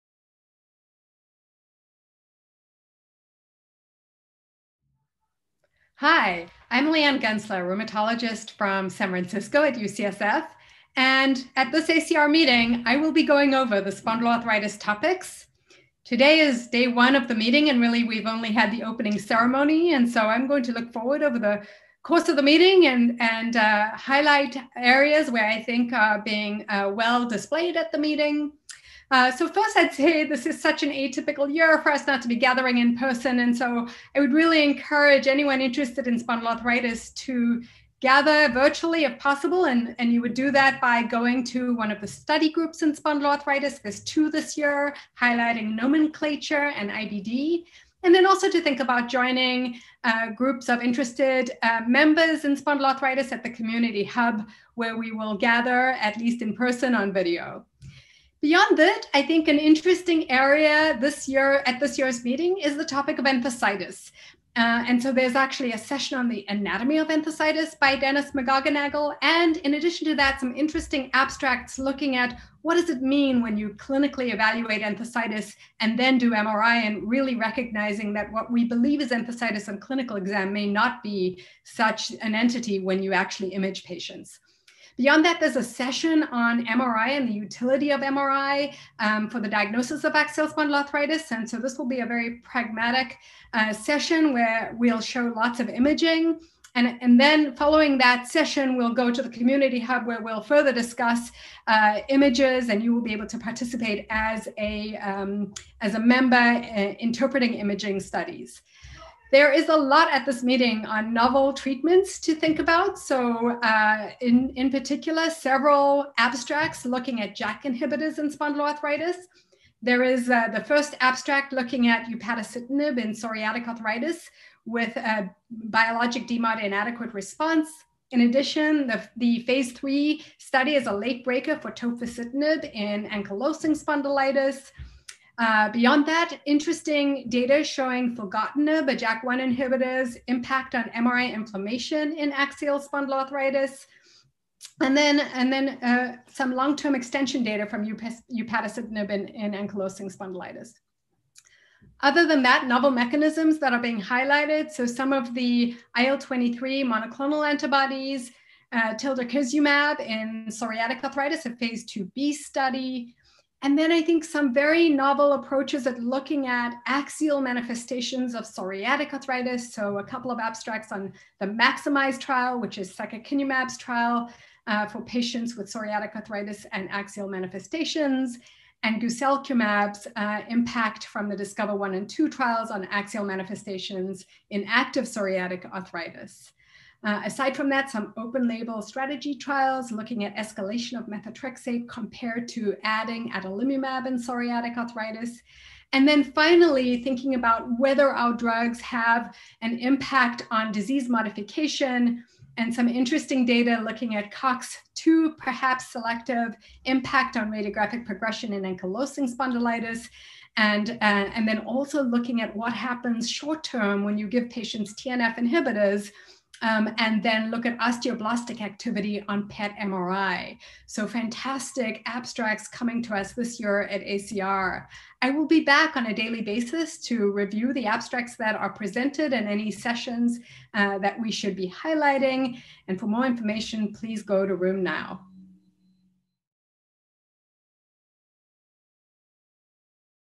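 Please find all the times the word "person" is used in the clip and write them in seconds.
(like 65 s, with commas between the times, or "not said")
32 s, 56 s.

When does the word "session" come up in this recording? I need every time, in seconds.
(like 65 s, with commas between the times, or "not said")
65 s, 85 s, 93 s, 98 s, 229 s.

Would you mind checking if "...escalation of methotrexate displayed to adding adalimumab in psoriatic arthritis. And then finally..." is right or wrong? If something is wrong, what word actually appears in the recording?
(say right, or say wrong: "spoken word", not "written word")
wrong: "compared", not "displayed".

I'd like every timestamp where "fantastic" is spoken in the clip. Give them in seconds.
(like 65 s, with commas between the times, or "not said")
221 s.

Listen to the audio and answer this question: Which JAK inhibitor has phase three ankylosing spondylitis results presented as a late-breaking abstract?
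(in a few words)
tofacitinib.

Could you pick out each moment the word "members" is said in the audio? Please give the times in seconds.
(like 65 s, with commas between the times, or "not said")
51 s, 105 s.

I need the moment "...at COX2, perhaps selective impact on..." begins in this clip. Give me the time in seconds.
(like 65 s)
204 s.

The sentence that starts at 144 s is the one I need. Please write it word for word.
And then, and then uh, some long-term extension data from upadacitinib in, in ankylosing spondylitis.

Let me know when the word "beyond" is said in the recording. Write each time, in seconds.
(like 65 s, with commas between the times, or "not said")
58 s, 84 s, 135 s.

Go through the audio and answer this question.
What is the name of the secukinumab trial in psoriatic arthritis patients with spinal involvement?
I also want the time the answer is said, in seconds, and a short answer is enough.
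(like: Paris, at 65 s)
Maximize, at 171 s.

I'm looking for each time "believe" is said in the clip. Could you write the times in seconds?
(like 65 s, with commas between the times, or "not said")
78 s.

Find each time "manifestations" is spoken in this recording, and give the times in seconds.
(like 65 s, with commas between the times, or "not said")
167 s, 177 s, 183 s.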